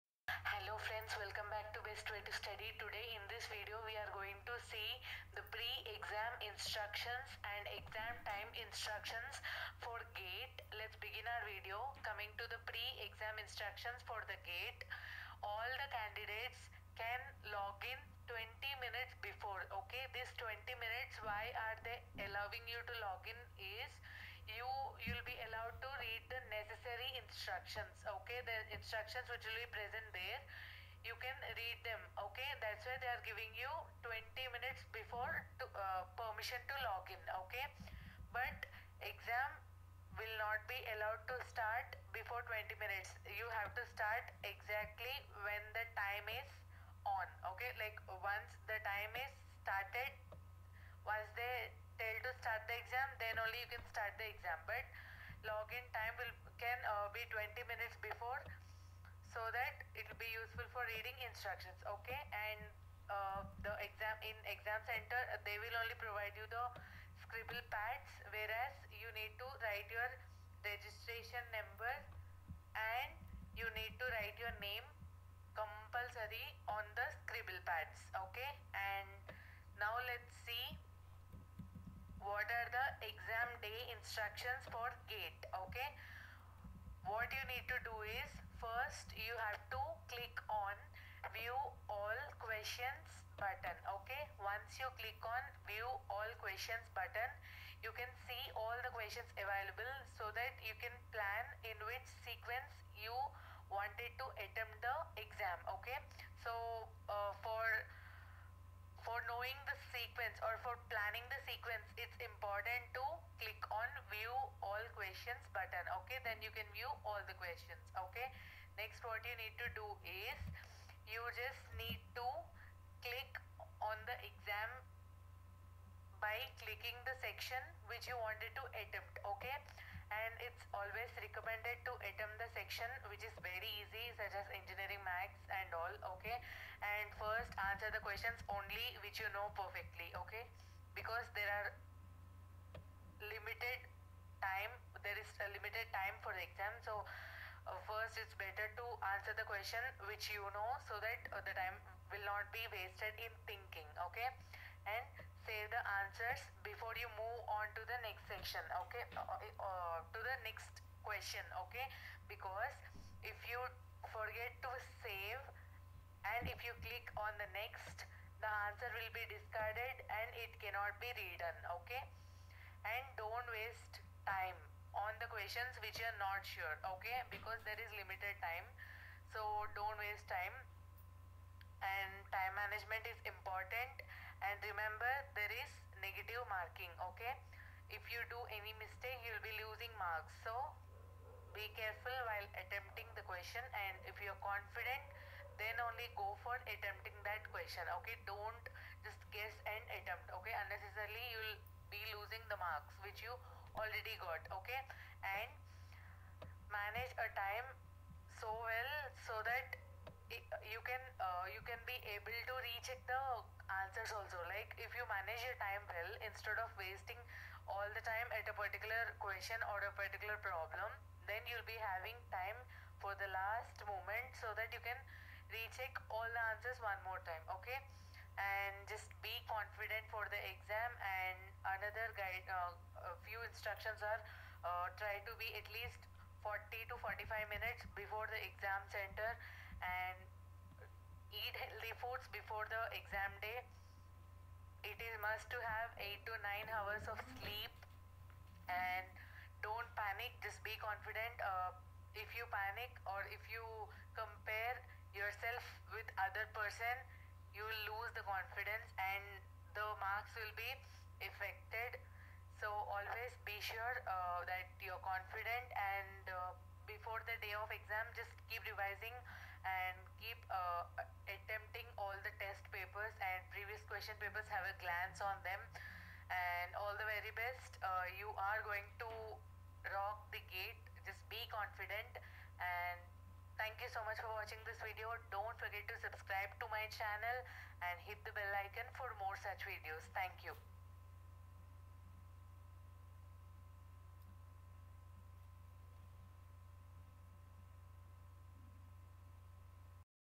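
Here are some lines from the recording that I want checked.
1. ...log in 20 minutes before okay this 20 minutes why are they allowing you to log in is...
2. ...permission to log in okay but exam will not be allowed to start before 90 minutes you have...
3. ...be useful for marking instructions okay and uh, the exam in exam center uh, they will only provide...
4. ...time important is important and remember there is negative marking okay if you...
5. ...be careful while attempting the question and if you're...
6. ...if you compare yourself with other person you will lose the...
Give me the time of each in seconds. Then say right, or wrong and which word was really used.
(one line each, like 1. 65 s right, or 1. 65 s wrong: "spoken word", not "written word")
1. 17 s right
2. 36 s wrong: "20", not "90"
3. 60 s wrong: "reading", not "marking"
4. 182 s wrong: "management", not "important"
5. 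191 s right
6. 253 s right.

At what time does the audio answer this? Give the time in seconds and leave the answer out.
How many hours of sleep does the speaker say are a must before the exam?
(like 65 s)
245 s.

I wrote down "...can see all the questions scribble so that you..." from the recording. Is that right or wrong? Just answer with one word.
wrong.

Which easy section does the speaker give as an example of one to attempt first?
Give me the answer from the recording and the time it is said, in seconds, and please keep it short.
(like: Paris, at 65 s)
engineering Maths, at 134 s.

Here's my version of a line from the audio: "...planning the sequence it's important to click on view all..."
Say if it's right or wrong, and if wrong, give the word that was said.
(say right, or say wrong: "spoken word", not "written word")
right.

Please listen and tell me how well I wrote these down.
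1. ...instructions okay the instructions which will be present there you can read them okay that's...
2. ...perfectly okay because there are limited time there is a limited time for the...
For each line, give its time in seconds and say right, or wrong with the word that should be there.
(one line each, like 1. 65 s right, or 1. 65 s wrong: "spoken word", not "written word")
1. 27 s right
2. 139 s right.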